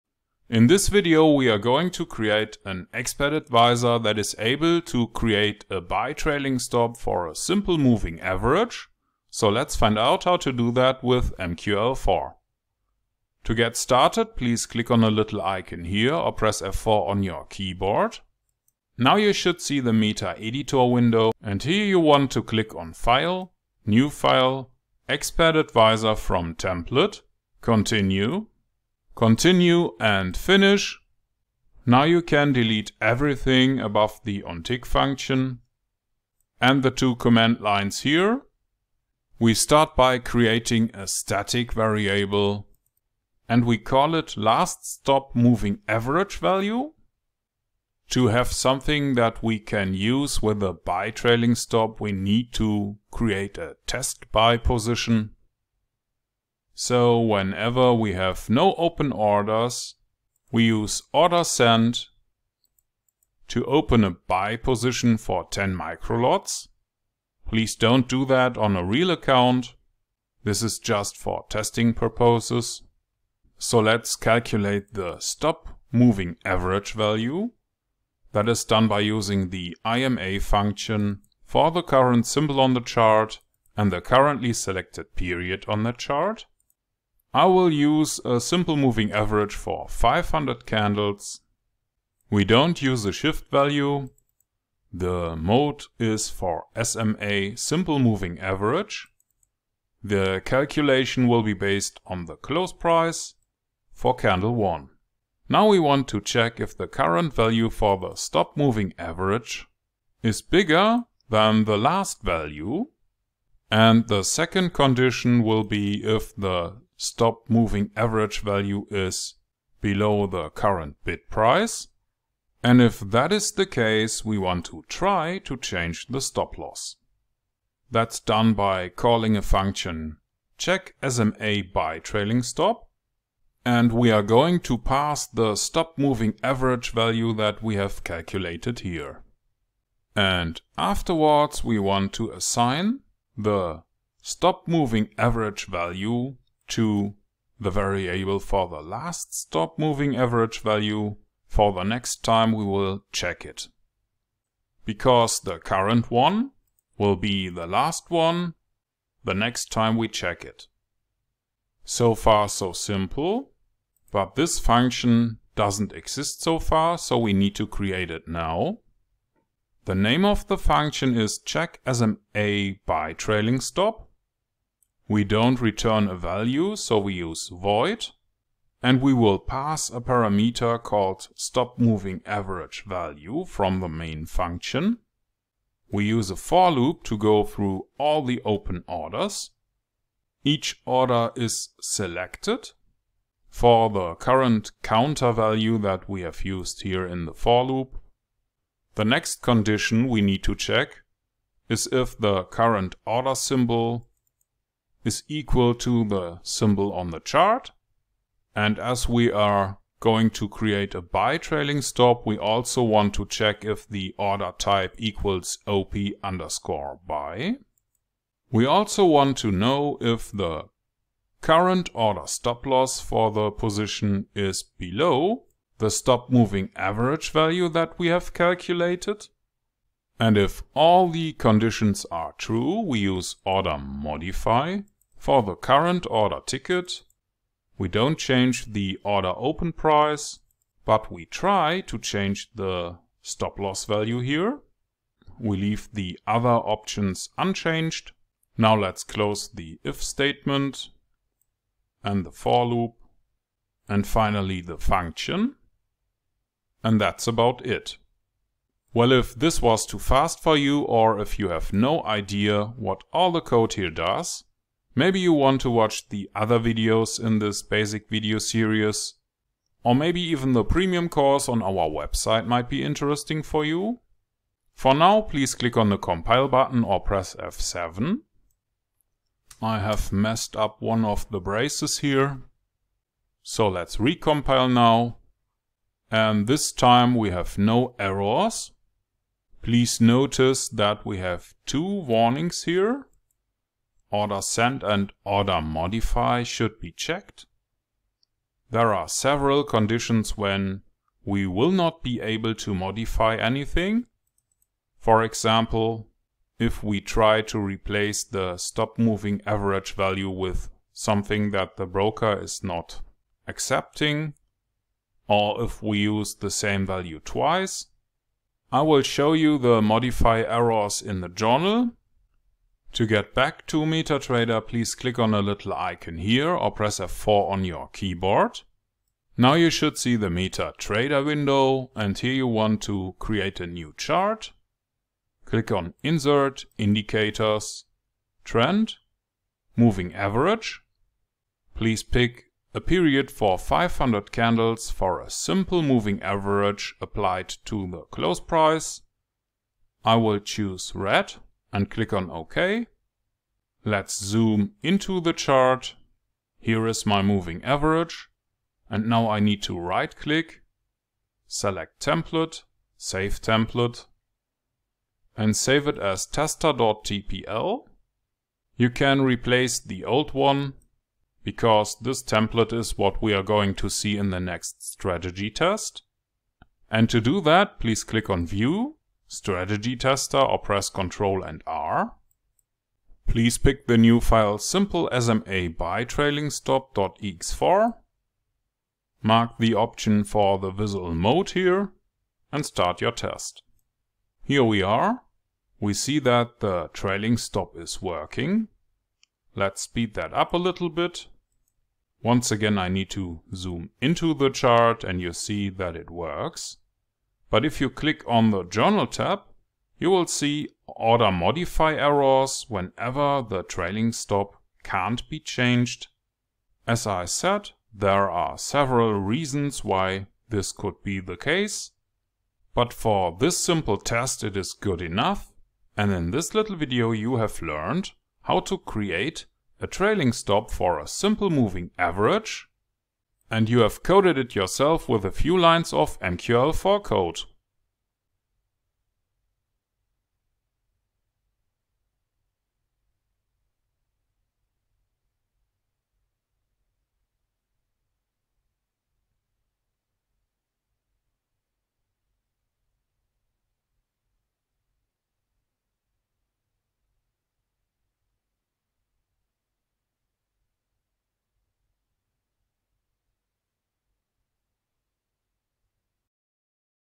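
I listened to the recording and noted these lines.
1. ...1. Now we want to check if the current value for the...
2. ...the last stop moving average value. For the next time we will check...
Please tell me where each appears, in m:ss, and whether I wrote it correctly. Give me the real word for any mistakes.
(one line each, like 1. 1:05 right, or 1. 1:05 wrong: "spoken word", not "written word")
1. 1:44 right
2. 2:28 right.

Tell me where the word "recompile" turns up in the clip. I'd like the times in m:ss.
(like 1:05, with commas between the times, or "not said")
4:43.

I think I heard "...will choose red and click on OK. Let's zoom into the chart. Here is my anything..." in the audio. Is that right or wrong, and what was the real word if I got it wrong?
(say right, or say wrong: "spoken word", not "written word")
wrong: "moving", not "anything".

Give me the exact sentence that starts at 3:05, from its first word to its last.
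We use a for loop to go through all the open orders.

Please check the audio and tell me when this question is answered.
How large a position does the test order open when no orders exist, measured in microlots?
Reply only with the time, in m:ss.
1:05.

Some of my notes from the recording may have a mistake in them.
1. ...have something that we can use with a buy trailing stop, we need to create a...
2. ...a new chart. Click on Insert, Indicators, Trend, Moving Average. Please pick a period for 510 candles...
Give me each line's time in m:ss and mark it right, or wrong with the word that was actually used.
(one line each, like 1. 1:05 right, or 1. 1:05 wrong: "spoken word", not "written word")
1. 0:48 right
2. 5:33 wrong: "500", not "510".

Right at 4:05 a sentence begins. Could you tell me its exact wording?
We leave the other options unchanged.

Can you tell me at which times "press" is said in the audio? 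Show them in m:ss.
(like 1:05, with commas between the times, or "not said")
0:16, 4:36, 5:26, 6:20.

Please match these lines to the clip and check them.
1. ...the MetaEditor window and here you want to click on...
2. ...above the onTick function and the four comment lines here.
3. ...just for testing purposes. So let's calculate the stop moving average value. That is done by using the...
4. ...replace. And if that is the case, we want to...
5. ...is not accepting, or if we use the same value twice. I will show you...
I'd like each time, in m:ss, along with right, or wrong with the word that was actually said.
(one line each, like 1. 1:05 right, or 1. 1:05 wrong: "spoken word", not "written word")
1. 0:19 right
2. 0:33 wrong: "two", not "four"
3. 1:10 right
4. 2:01 wrong: "price", not "replace"
5. 5:12 right.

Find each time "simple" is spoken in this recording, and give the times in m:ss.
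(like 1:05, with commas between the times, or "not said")
0:07, 1:28, 1:37, 2:42, 5:45, 6:24, 7:03, 7:11.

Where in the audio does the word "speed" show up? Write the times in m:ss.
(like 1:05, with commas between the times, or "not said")
6:39.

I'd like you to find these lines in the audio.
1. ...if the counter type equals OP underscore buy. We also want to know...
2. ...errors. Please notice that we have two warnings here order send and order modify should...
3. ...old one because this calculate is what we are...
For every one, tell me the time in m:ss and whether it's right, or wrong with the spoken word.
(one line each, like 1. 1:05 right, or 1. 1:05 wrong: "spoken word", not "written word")
1. 3:33 wrong: "order", not "counter"
2. 4:47 right
3. 6:10 wrong: "template", not "calculate".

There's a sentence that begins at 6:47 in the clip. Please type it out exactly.
But if you click on the Journal tab, you will see order modify errors whenever the trailing stop can't be changed.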